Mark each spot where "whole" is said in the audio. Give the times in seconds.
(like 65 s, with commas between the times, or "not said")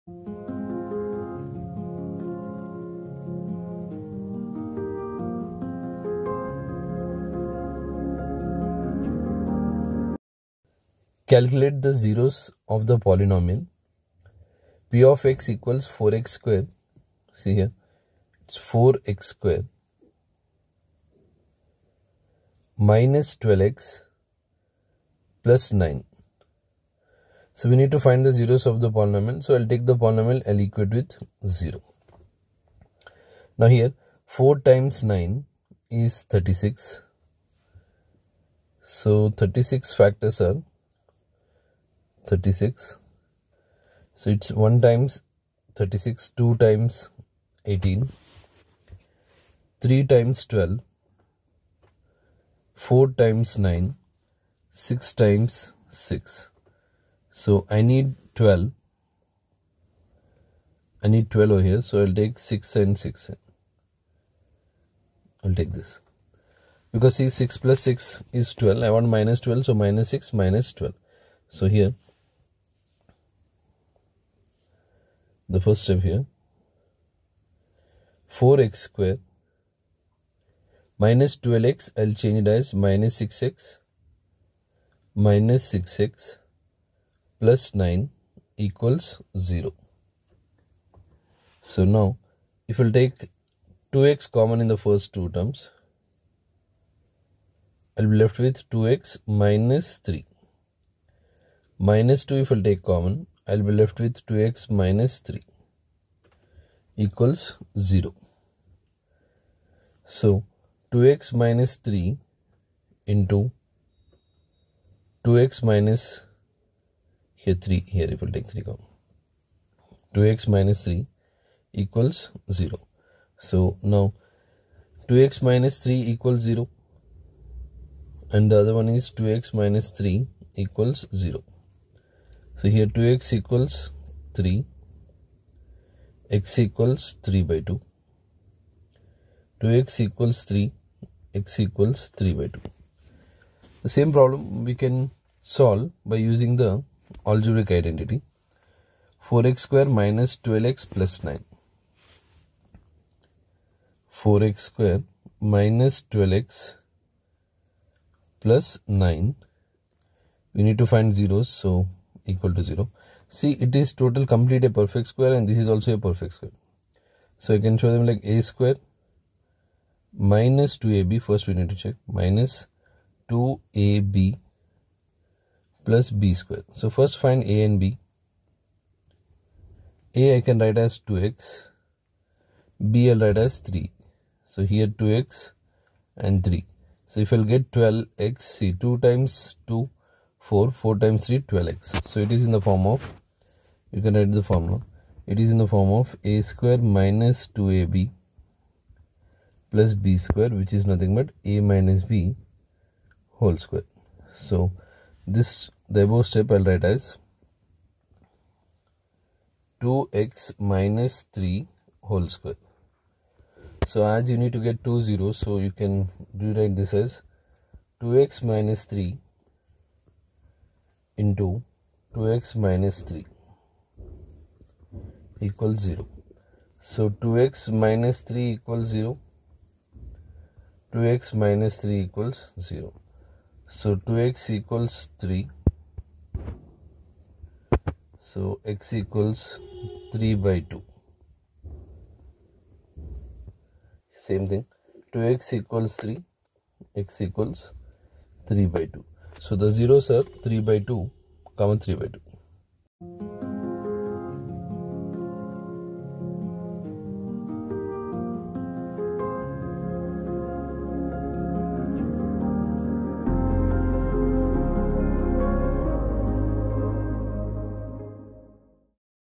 203 s, 212 s.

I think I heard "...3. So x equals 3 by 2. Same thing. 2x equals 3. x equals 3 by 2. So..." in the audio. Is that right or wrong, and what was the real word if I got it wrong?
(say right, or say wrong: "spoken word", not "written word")
right.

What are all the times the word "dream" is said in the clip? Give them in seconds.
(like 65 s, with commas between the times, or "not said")
not said.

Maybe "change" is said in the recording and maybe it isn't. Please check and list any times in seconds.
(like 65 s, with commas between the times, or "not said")
82 s.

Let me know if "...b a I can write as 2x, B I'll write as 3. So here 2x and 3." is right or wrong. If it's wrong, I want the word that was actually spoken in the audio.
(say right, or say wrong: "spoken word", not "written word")
right.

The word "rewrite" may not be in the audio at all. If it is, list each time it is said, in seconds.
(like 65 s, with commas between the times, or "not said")
216 s.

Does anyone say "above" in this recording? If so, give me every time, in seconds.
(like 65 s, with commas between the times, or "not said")
206 s.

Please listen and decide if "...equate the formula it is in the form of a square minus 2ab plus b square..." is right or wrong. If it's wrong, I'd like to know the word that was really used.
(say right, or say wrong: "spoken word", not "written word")
wrong: "write", not "equate".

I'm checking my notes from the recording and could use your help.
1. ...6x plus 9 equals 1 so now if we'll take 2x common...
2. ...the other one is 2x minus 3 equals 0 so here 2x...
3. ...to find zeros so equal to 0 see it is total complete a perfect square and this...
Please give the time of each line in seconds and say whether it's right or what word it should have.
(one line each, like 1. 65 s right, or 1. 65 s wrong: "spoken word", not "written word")
1. 85 s wrong: "0", not "1"
2. 128 s right
3. 160 s right.